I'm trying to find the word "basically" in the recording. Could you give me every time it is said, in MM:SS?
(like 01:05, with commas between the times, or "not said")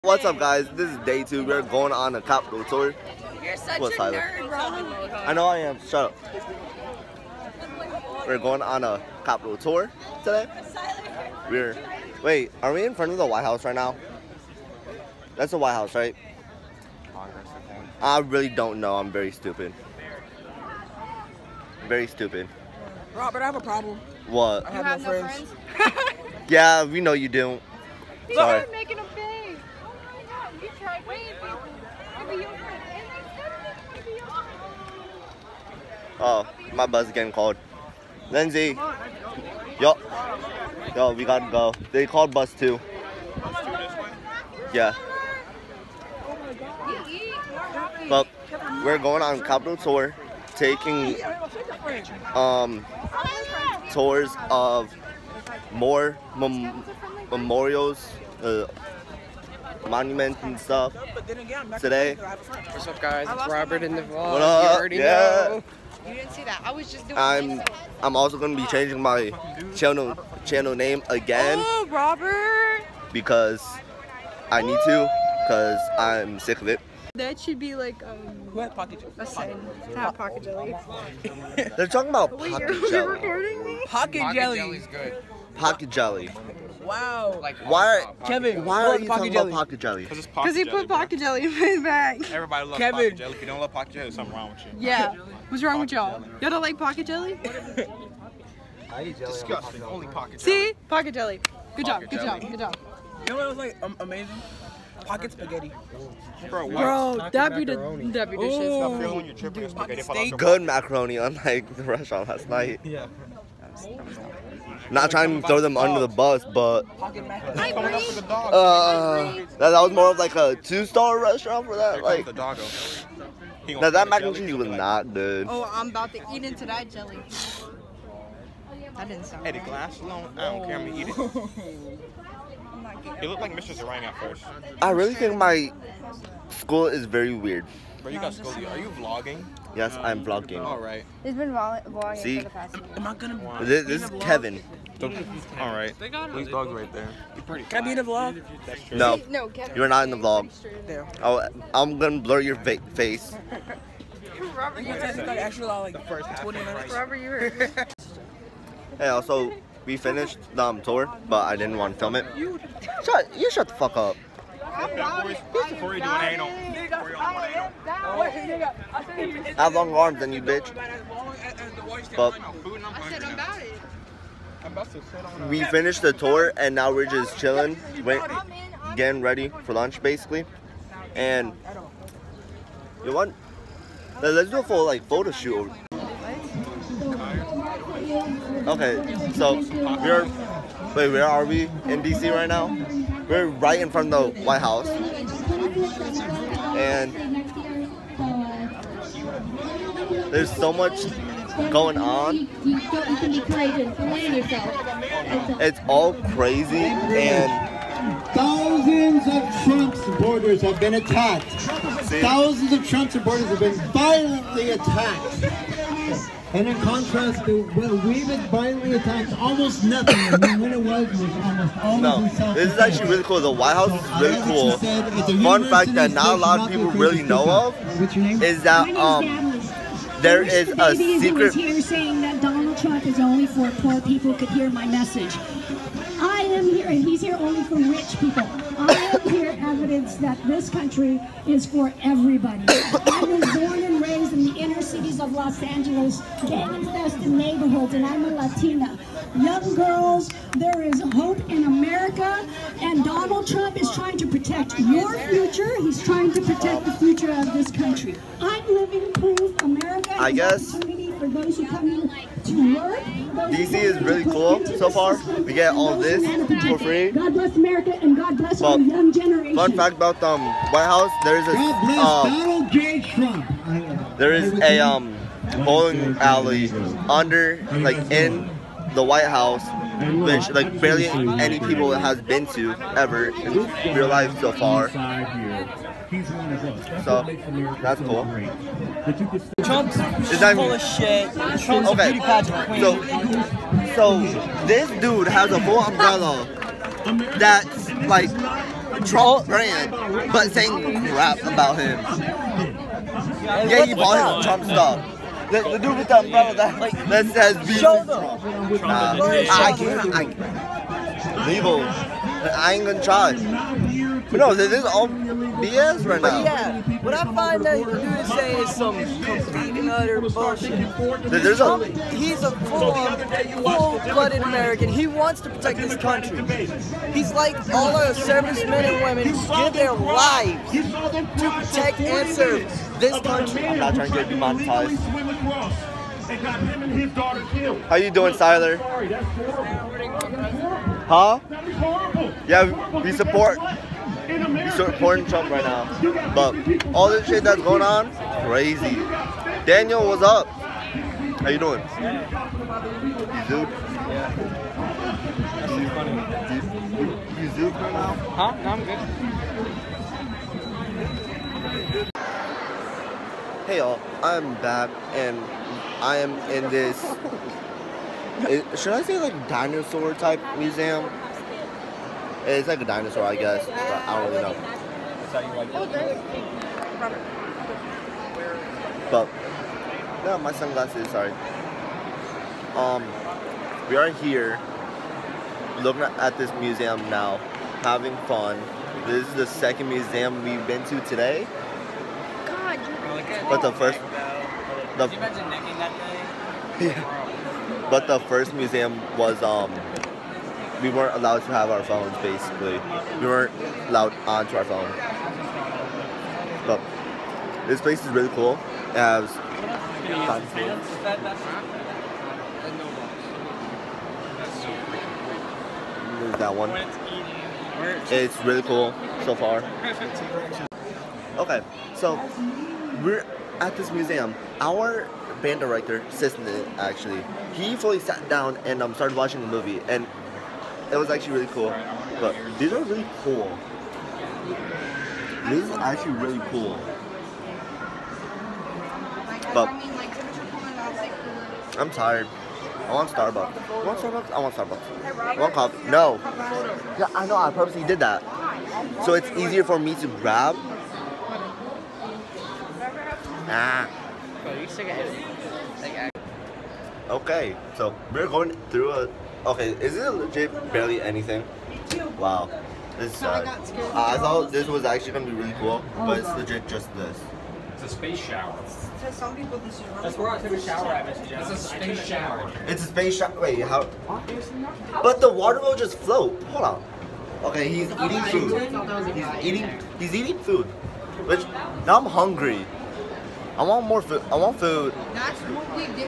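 03:00, 06:42.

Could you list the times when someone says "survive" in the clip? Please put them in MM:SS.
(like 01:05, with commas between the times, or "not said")
not said.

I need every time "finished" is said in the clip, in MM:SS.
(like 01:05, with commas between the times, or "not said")
02:39, 02:55.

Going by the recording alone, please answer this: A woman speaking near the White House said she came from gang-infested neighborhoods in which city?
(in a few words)
Los Angeles.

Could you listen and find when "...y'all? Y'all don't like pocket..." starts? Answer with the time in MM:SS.
01:35.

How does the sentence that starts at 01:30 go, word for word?
Because he put jelly, pocket jelly in his bag.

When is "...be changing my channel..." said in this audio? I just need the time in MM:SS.
01:08.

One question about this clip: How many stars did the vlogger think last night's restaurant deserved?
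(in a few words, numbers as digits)
2.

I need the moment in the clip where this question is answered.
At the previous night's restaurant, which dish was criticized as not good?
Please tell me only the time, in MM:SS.
02:04.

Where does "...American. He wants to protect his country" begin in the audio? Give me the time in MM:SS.
05:24.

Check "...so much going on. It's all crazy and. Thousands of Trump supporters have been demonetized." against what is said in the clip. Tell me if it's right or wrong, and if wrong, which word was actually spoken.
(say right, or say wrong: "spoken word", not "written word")
wrong: "attacked", not "demonetized".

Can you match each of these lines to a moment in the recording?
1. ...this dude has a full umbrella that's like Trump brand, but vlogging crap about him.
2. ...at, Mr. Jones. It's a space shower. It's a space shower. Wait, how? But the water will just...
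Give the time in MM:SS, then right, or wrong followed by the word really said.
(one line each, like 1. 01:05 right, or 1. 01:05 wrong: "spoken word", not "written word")
1. 04:54 wrong: "saying", not "vlogging"
2. 07:50 right.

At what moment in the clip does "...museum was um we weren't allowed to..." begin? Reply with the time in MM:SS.
06:38.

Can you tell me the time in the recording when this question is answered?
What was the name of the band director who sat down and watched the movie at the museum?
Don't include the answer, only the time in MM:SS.
07:06.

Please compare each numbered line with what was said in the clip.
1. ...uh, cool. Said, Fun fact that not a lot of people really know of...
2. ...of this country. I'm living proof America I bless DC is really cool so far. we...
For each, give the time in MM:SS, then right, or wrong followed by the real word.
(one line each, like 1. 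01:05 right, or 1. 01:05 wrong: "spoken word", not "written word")
1. 03:44 right
2. 04:17 wrong: "guess", not "bless".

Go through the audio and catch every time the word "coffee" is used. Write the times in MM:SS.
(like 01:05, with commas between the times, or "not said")
07:25.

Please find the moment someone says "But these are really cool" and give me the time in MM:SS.
07:12.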